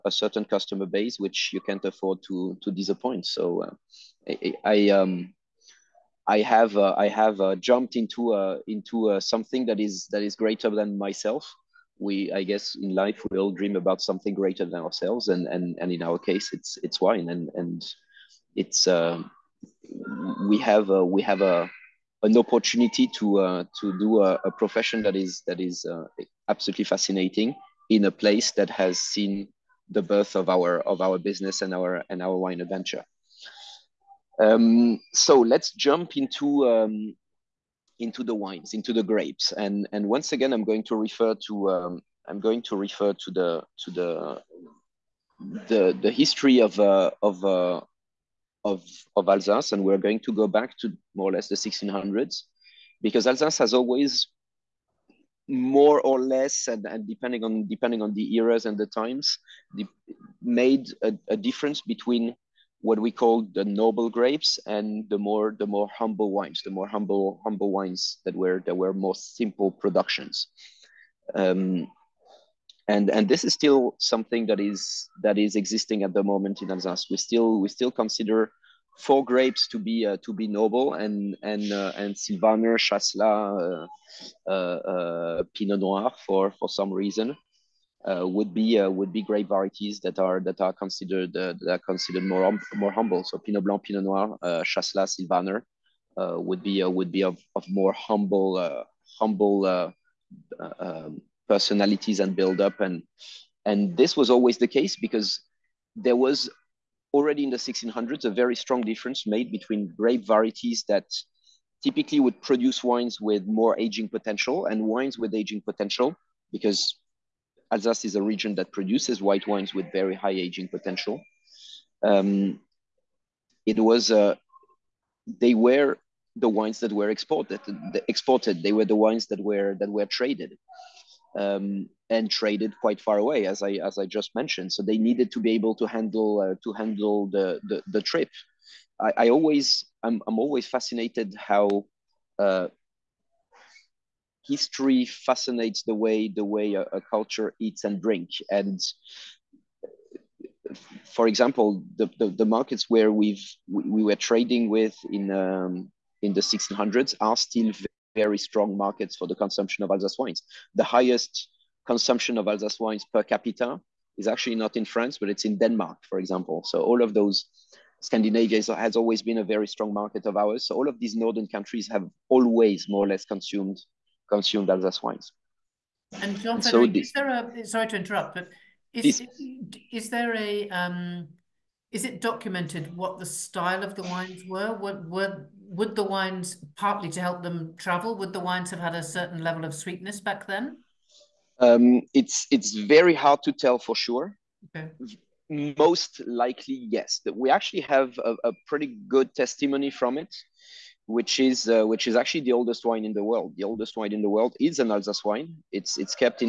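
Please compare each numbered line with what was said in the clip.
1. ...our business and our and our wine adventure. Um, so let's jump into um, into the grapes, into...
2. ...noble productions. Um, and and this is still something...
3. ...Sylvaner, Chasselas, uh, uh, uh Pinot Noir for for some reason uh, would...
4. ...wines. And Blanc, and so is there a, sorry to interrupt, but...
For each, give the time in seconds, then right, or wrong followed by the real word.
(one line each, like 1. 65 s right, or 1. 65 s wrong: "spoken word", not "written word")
1. 31 s wrong: "wines", not "grapes"
2. 69 s wrong: "simple", not "noble"
3. 82 s right
4. 175 s wrong: "John", not "Blanc".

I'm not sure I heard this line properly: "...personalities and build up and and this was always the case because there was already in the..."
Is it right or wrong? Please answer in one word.
right.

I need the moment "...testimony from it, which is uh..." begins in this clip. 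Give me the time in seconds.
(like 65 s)
199 s.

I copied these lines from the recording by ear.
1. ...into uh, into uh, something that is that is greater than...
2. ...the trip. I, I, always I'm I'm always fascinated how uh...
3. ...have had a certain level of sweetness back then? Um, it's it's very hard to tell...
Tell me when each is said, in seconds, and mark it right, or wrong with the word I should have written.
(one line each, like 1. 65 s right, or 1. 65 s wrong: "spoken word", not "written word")
1. 7 s right
2. 137 s right
3. 188 s right.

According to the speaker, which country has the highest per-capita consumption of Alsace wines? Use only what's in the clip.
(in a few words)
Denmark.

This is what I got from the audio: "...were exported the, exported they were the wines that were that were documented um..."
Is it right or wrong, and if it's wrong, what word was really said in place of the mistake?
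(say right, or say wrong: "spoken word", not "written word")
wrong: "traded", not "documented".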